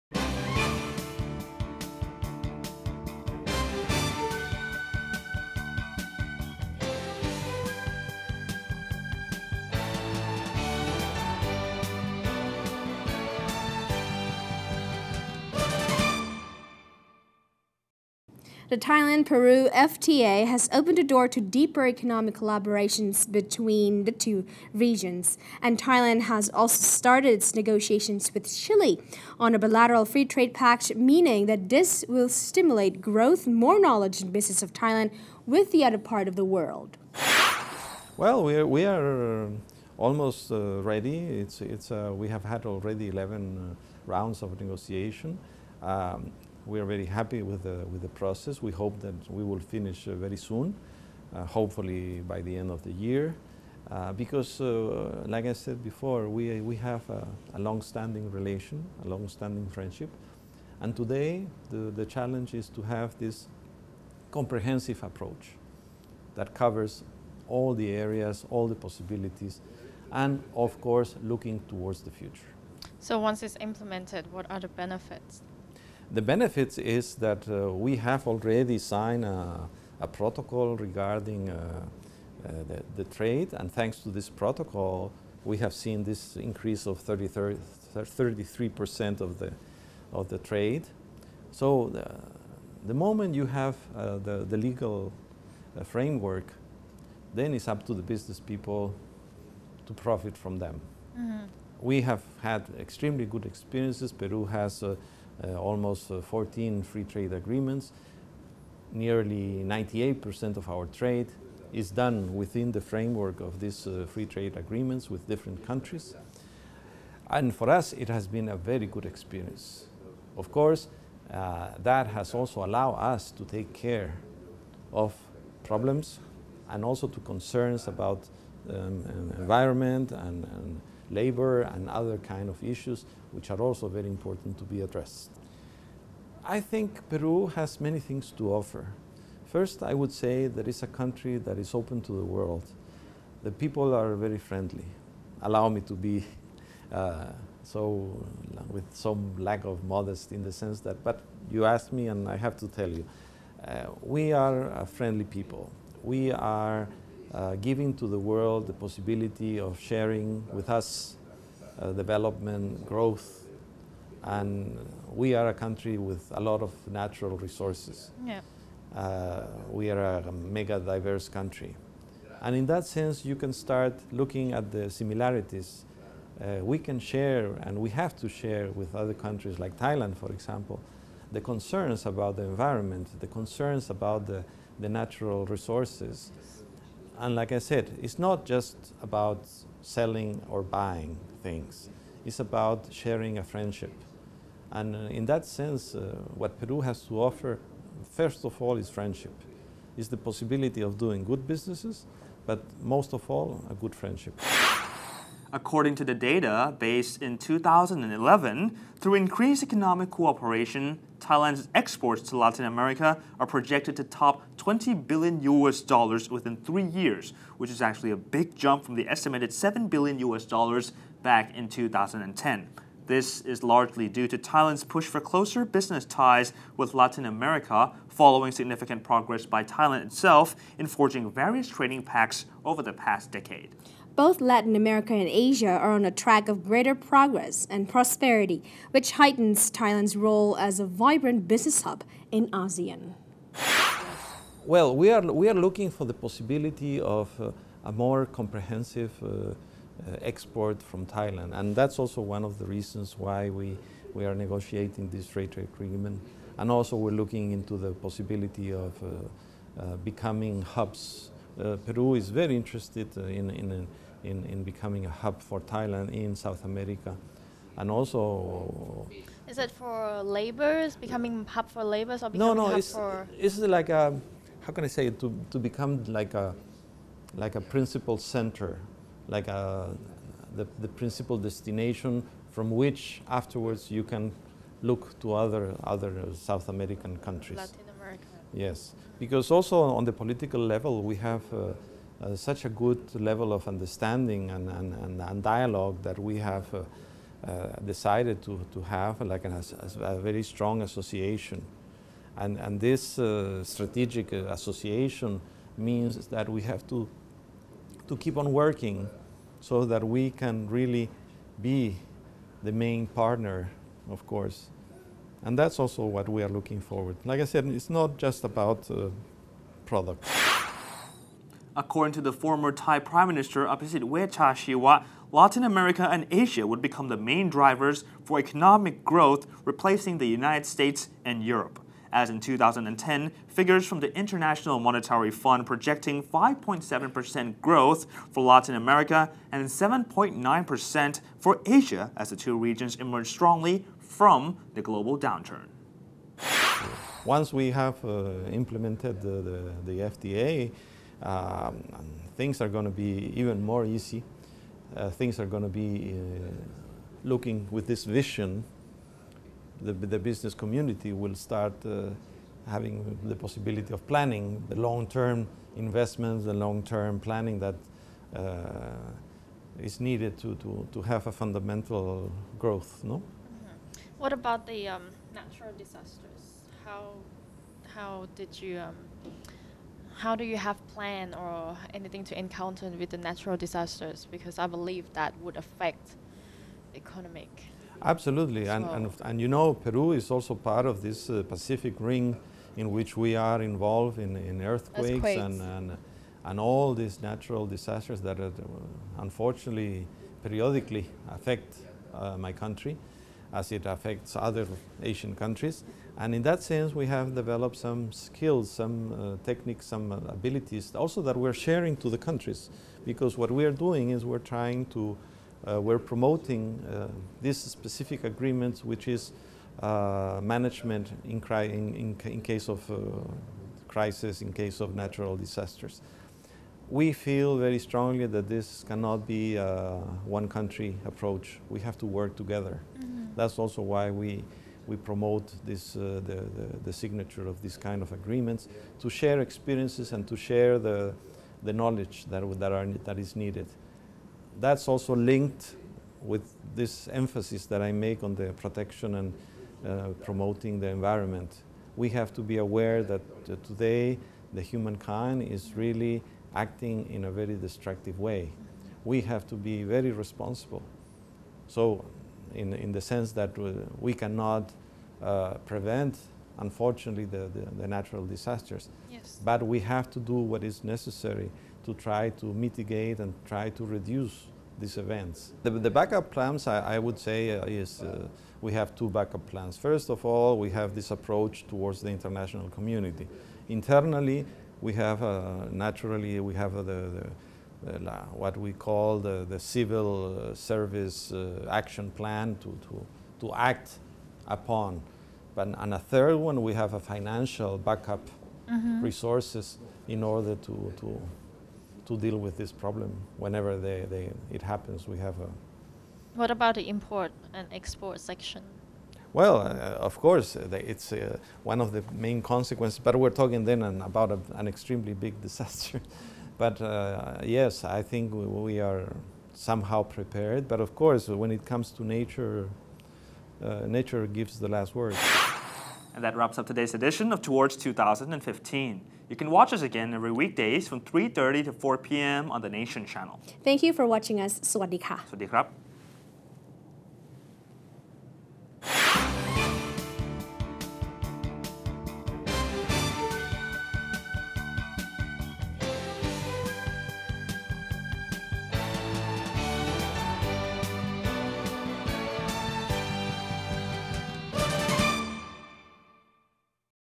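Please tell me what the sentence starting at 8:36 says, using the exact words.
but uh, yes, I think we, we, are somehow prepared.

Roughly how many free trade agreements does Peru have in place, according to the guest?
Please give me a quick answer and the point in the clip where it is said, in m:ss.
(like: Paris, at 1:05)
14, at 1:46.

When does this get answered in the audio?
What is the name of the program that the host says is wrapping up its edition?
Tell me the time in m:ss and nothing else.
8:47.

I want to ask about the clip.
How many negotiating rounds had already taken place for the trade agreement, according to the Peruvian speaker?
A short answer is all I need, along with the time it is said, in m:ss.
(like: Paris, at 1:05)
11, at 0:43.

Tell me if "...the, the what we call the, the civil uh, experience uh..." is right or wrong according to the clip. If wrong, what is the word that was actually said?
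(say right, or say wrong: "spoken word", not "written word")
wrong: "service", not "experience".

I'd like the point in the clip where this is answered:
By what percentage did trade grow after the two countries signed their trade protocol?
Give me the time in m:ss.
1:27.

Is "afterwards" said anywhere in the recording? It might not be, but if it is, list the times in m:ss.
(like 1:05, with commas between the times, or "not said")
4:43.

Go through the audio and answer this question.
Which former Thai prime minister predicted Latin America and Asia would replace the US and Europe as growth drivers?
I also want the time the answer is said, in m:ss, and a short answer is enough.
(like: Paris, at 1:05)
Abhisit Vejjajiva, at 5:23.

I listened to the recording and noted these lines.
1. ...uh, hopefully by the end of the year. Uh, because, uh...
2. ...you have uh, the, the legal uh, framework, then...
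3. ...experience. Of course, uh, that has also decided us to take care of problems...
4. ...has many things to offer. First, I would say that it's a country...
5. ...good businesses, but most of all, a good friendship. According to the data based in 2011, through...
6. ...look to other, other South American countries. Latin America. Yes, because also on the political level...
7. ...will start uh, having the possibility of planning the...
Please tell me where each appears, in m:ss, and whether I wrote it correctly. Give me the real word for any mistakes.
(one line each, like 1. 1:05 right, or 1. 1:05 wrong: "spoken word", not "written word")
1. 0:51 right
2. 1:33 right
3. 1:59 wrong: "allowed", not "decided"
4. 2:17 right
5. 3:21 right
6. 4:44 right
7. 6:01 right.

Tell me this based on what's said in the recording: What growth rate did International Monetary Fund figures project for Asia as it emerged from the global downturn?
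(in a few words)
7.9%.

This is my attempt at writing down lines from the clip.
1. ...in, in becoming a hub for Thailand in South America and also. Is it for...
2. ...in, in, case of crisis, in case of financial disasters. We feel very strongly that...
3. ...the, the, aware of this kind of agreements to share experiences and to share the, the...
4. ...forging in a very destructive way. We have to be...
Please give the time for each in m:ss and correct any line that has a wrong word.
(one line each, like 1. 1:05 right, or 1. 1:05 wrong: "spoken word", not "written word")
1. 4:24 right
2. 7:01 wrong: "natural", not "financial"
3. 7:16 wrong: "signature", not "aware"
4. 7:36 wrong: "acting", not "forging".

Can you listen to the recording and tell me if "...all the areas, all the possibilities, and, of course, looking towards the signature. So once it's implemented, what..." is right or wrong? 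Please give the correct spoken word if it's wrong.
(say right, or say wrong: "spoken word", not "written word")
wrong: "future", not "signature".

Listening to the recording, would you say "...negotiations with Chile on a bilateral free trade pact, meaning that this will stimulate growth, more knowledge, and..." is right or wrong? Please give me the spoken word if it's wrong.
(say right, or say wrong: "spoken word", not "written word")
right.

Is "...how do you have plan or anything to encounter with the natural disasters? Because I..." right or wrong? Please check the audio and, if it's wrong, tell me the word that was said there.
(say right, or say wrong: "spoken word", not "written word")
right.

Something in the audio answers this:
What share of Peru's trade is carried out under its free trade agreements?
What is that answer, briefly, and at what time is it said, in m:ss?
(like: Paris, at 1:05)
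98%, at 1:49.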